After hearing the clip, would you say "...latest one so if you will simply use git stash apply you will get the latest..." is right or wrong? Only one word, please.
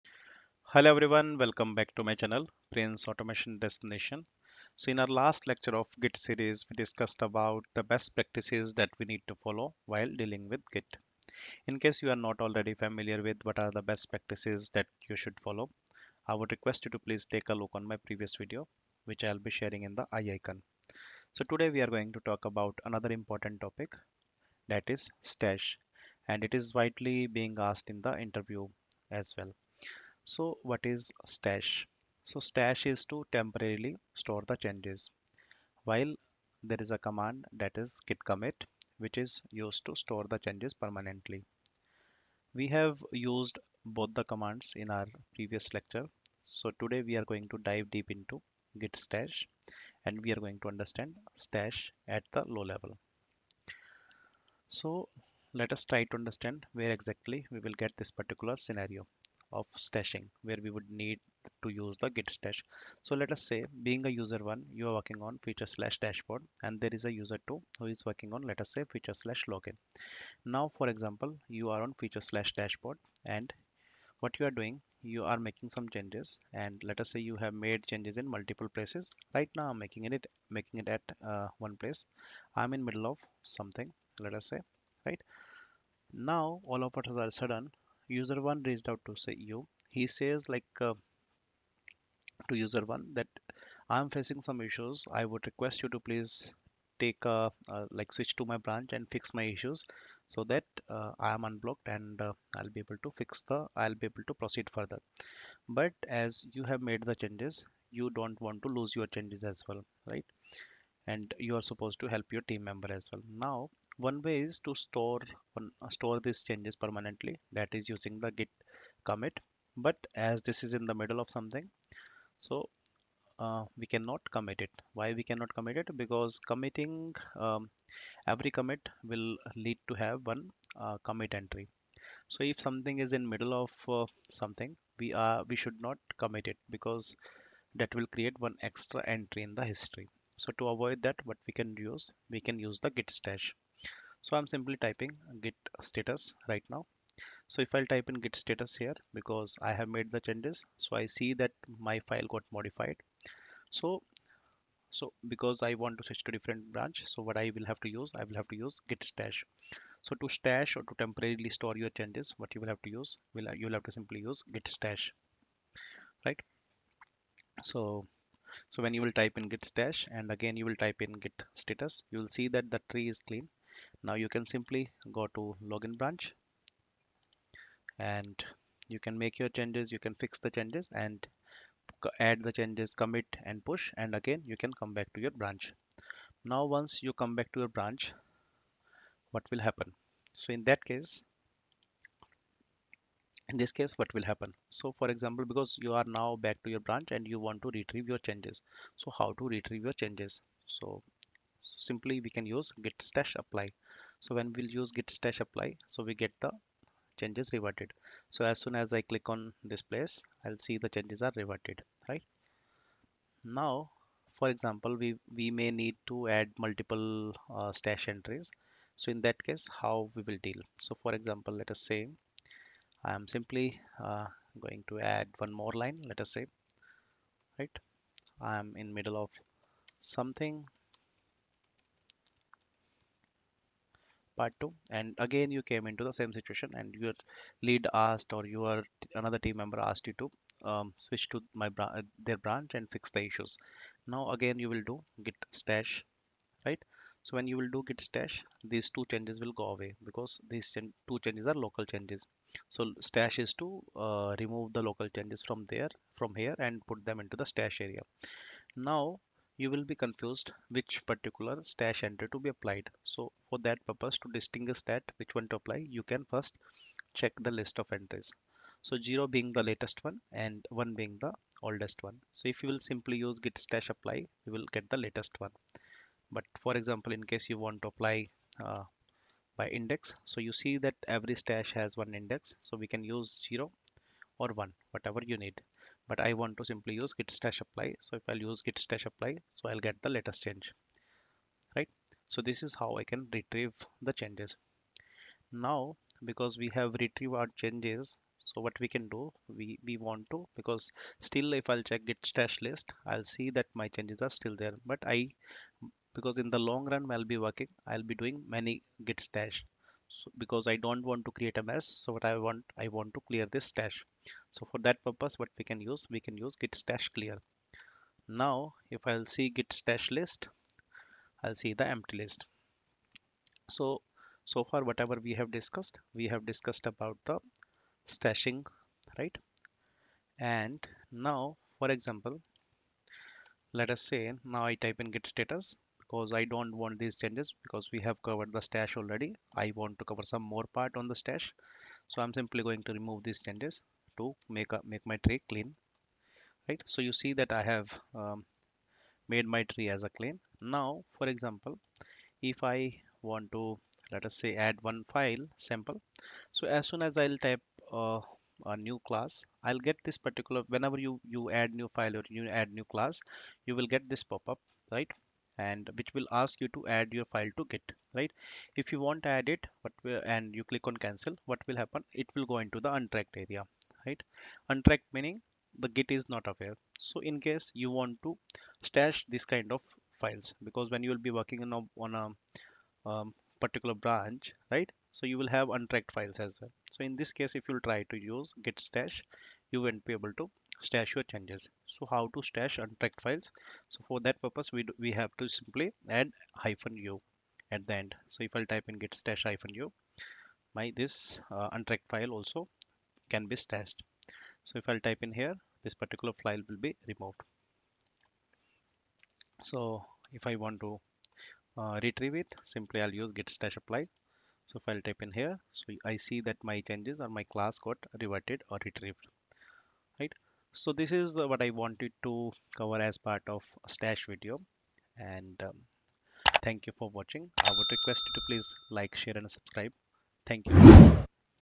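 wrong.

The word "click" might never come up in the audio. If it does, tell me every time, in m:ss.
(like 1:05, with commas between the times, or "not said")
3:29, 6:10.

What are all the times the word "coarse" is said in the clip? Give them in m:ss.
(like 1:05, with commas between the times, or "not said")
not said.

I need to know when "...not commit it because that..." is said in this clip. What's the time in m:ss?
2:15.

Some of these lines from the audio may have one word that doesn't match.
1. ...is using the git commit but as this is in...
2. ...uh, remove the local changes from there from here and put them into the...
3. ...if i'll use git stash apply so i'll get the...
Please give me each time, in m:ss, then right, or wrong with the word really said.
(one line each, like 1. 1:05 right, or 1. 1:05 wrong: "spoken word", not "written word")
1. 1:57 right
2. 4:13 right
3. 4:48 right.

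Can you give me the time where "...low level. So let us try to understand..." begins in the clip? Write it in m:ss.
0:52.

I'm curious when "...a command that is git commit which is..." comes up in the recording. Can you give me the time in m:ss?
0:36.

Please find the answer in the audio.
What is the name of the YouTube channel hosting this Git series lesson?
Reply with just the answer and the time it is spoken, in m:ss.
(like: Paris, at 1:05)
Prince Automation Destination, at 0:02.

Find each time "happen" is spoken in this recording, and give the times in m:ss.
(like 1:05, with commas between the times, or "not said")
3:09, 3:14, 6:11.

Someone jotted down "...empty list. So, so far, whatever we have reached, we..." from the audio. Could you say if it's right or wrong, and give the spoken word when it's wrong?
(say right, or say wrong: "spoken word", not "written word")
wrong: "discussed", not "reached".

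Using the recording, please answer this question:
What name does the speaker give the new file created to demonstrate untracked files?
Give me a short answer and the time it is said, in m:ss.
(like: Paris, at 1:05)
sample, at 5:55.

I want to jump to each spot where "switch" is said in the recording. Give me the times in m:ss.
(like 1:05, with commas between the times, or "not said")
1:38, 2:36, 4:00.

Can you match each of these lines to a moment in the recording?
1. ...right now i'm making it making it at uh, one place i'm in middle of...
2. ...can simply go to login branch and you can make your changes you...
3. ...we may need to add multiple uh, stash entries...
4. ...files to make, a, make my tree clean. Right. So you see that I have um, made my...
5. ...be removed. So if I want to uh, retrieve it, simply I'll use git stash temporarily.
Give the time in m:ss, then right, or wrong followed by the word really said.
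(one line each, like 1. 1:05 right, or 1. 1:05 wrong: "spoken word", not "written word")
1. 1:19 right
2. 2:54 right
3. 3:35 right
4. 5:43 wrong: "changes", not "files"
5. 6:46 wrong: "apply", not "temporarily".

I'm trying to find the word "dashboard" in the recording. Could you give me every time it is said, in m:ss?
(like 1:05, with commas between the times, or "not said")
1:05, 1:12.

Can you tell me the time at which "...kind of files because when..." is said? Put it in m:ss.
6:19.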